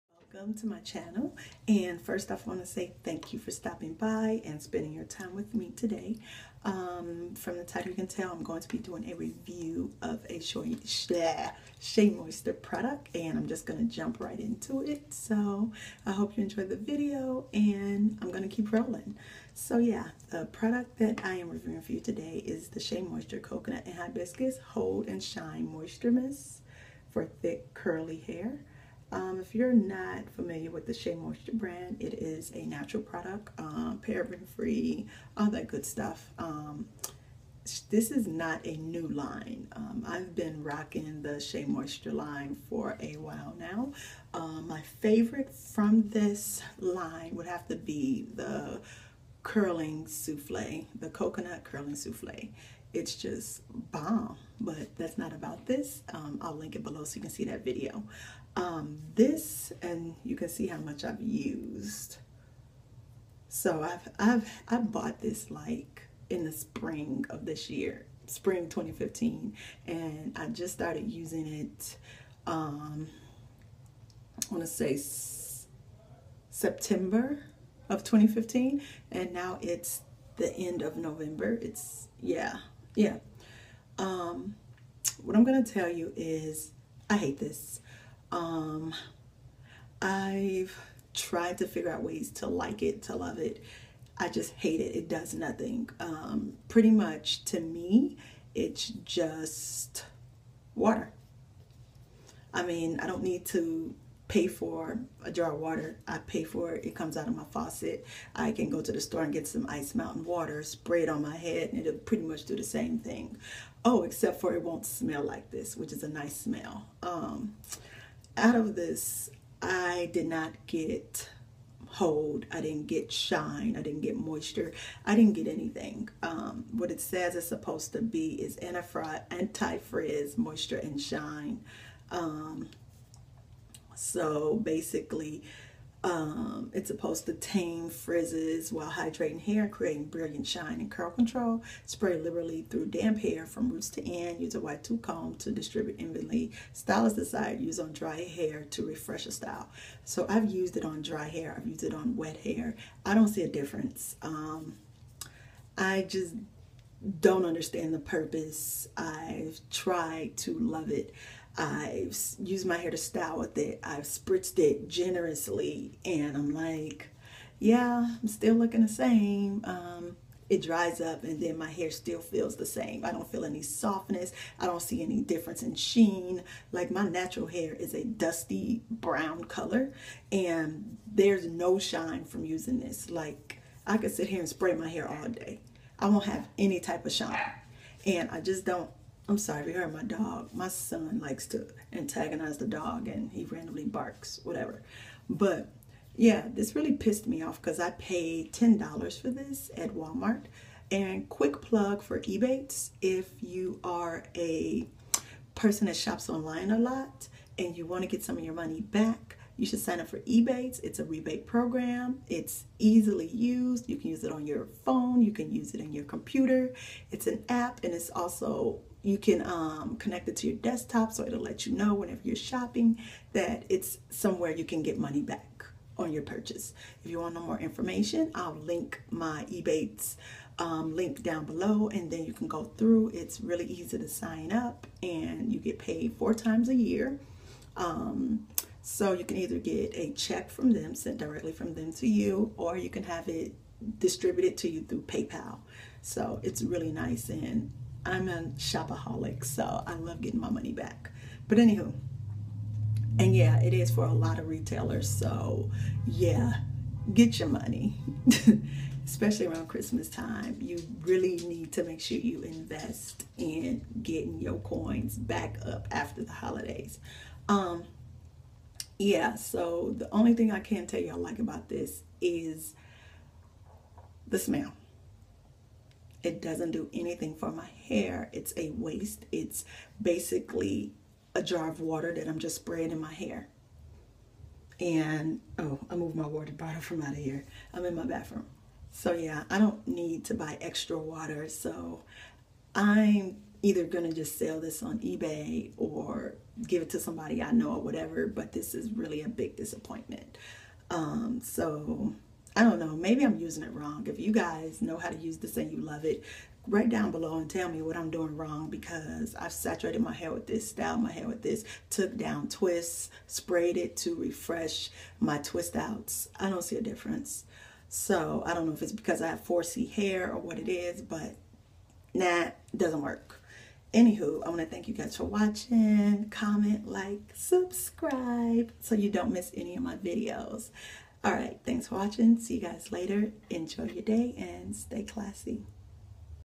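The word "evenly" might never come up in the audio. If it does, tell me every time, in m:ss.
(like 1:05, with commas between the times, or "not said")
2:26.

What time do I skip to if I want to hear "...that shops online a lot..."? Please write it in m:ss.
3:25.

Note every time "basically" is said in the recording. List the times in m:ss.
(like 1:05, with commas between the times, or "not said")
2:14, 4:40.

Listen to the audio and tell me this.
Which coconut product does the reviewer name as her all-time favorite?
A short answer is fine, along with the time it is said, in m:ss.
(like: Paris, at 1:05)
Coconut curling souffle, at 0:50.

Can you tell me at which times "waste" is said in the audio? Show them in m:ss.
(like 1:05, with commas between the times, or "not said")
4:38.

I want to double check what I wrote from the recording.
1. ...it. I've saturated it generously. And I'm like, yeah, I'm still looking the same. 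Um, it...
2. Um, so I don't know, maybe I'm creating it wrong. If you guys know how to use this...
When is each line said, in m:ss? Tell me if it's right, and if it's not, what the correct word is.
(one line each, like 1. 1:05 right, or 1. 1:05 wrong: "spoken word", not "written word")
1. 2:43 wrong: "spritzed", not "saturated"
2. 5:00 wrong: "using", not "creating".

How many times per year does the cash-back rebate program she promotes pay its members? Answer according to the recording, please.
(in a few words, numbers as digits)
4.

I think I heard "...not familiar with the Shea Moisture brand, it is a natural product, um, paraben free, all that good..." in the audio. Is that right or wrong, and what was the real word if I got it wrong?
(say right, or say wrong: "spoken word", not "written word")
right.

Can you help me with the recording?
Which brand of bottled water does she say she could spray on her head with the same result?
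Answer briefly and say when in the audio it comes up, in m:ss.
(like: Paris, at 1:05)
Ice Mountain, at 1:49.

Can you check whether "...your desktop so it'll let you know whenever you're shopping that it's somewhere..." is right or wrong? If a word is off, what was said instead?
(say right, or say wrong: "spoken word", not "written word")
right.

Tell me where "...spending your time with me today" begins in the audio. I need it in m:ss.
0:04.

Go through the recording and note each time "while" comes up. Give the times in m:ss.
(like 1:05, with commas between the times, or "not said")
0:43, 2:18.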